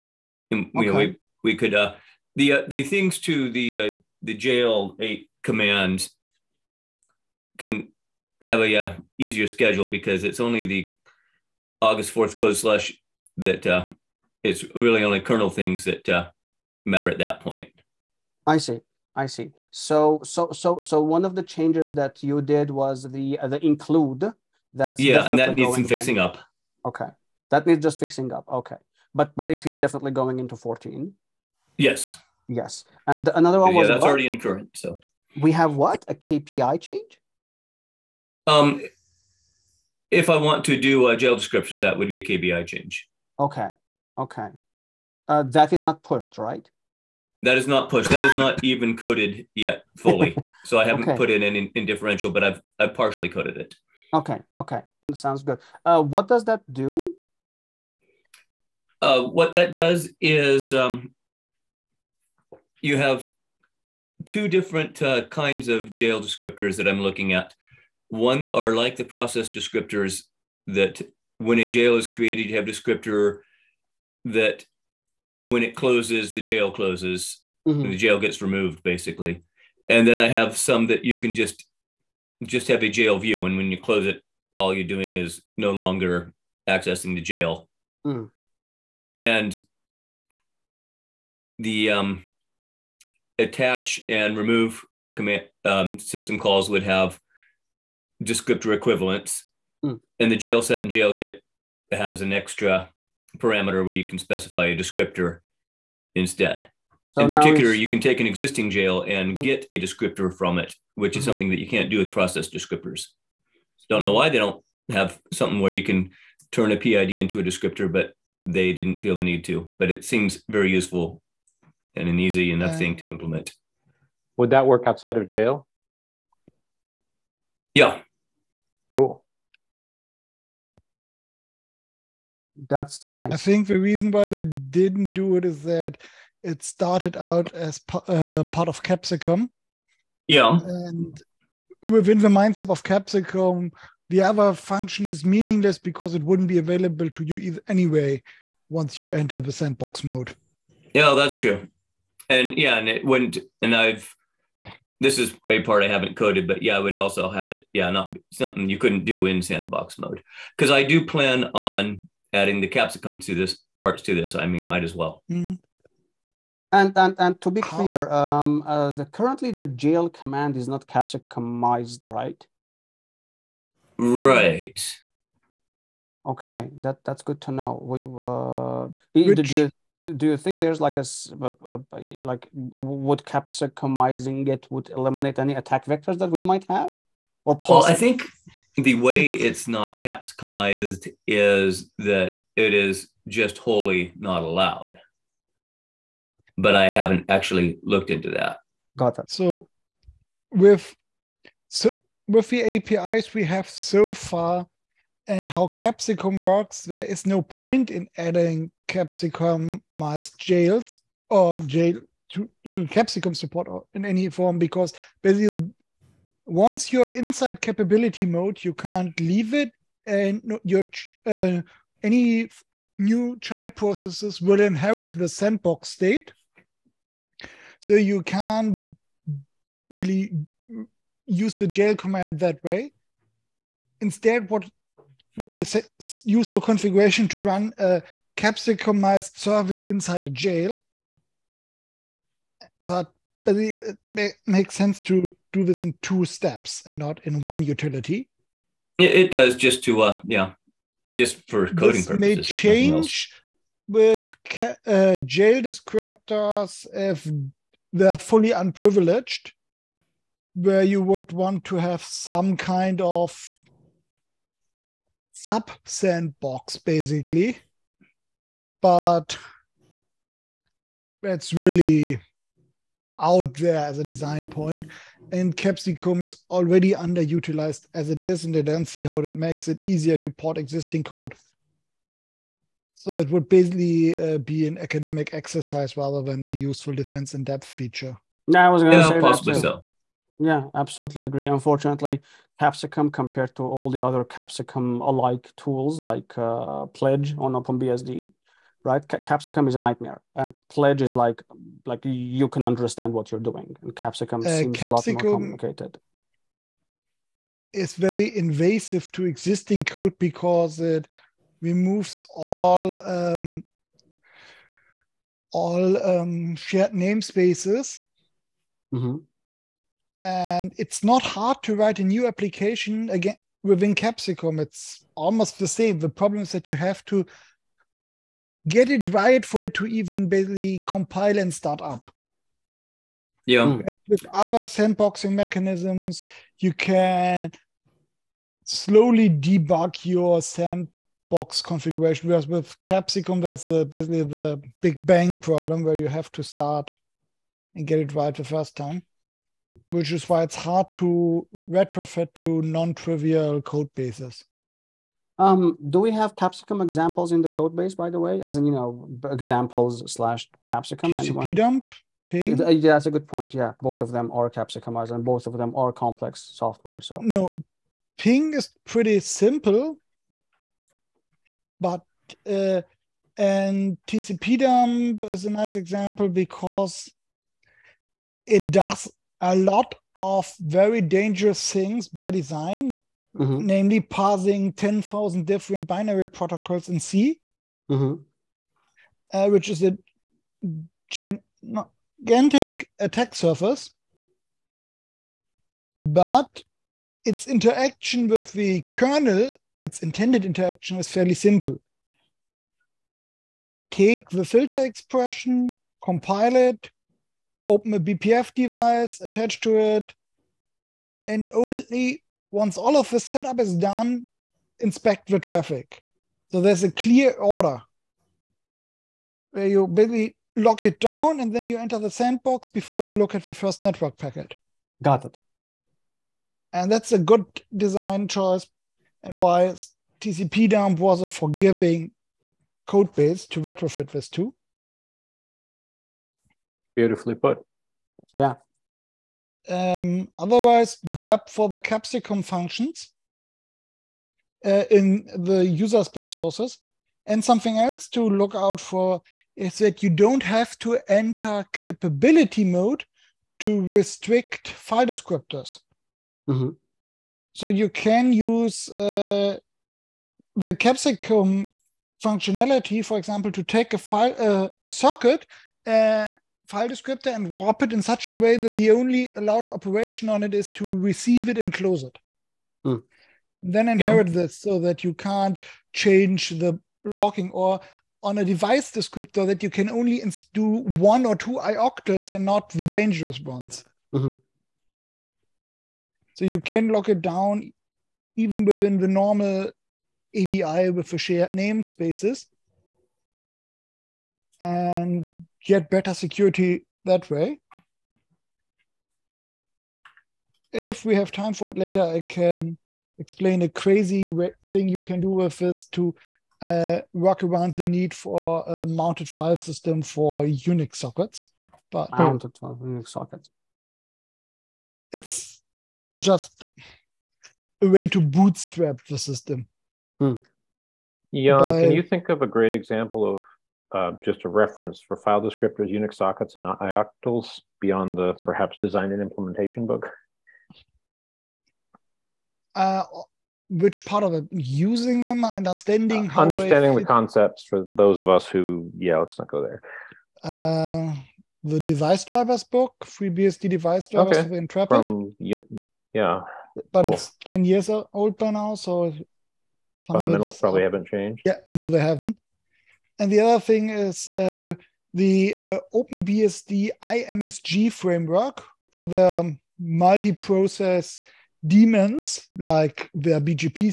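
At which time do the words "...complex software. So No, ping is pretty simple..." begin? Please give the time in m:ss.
6:05.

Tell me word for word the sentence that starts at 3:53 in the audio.
Instead, what would be a useful configuration to run a capsicumized service inside a jail.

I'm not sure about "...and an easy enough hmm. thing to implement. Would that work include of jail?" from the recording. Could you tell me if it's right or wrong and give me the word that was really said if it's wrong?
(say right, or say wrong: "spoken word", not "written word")
wrong: "outside", not "include".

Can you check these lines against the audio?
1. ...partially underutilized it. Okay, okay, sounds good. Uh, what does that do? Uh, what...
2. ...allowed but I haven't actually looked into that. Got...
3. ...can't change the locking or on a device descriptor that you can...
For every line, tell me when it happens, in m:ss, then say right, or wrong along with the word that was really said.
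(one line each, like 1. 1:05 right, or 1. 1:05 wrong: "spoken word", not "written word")
1. 0:52 wrong: "coded", not "underutilized"
2. 3:14 right
3. 7:55 right.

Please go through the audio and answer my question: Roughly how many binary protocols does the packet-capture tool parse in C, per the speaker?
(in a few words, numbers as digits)
10,000.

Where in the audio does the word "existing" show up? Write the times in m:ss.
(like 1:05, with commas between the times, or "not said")
1:48, 4:40, 5:09.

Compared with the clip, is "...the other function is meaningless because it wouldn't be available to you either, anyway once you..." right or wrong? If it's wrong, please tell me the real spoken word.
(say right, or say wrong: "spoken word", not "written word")
right.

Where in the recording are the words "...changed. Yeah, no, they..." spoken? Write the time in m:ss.
9:11.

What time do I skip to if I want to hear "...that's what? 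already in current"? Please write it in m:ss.
0:33.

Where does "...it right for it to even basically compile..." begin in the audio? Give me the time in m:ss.
5:28.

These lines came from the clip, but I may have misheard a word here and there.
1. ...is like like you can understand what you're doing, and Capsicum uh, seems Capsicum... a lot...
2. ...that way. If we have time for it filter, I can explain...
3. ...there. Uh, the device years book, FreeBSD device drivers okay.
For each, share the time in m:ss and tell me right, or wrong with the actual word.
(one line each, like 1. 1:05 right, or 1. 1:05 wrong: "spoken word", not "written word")
1. 5:01 right
2. 8:17 wrong: "later", not "filter"
3. 8:59 wrong: "drivers", not "years".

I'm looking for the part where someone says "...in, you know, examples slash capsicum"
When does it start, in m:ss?
5:58.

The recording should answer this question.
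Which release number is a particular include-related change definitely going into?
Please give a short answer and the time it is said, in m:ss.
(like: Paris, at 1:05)
14, at 0:30.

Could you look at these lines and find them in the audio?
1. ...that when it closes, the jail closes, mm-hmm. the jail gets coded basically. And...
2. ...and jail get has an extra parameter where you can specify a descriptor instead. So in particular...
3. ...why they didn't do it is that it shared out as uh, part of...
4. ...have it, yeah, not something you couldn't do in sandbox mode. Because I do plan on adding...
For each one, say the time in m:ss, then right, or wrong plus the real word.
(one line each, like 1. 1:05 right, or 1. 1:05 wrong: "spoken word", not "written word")
1. 1:14 wrong: "removed", not "coded"
2. 1:40 right
3. 2:14 wrong: "started", not "shared"
4. 2:37 right.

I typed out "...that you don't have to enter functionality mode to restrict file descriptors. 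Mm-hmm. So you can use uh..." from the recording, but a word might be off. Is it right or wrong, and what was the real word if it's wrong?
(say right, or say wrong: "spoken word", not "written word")
wrong: "capability", not "functionality".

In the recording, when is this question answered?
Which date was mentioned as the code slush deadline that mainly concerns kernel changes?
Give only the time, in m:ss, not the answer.
0:11.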